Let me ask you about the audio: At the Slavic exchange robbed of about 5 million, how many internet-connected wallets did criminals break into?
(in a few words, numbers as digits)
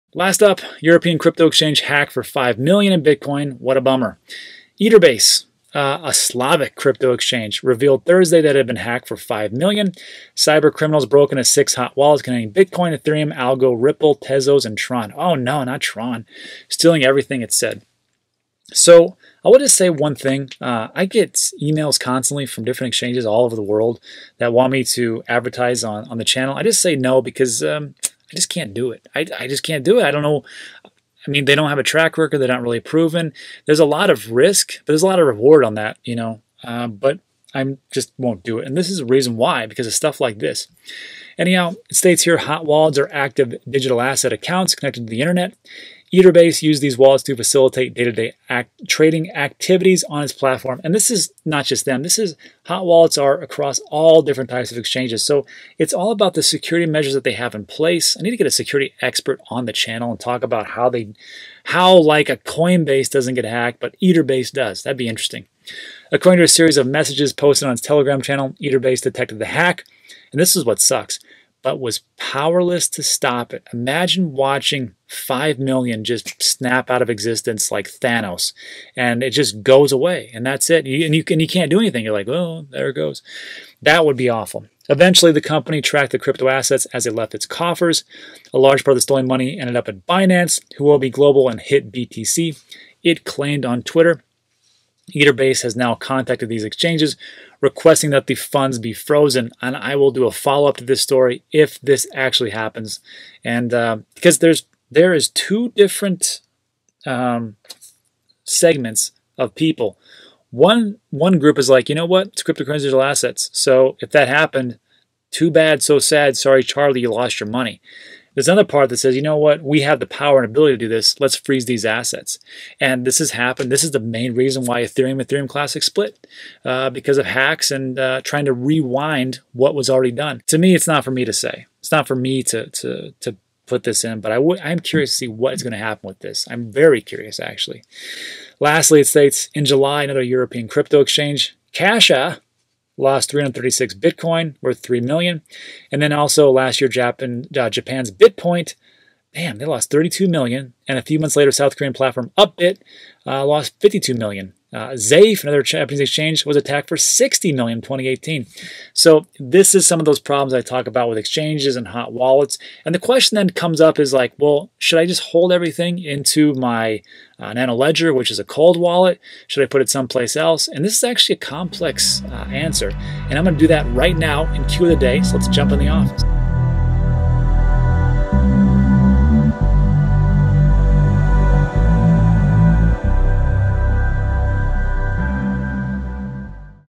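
6.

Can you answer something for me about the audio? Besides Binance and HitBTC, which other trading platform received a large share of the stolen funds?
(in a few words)
Huobi Global.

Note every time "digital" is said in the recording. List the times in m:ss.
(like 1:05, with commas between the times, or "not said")
0:43, 1:52.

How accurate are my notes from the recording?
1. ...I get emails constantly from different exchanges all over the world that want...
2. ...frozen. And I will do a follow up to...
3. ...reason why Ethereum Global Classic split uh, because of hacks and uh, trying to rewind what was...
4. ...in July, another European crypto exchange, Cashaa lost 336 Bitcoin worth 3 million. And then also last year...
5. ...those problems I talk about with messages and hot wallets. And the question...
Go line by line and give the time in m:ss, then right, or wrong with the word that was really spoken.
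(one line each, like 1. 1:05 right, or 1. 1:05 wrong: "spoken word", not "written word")
1. 0:20 right
2. 1:38 right
3. 2:04 wrong: "Ethereum", not "Global"
4. 2:19 right
5. 2:40 wrong: "exchanges", not "messages".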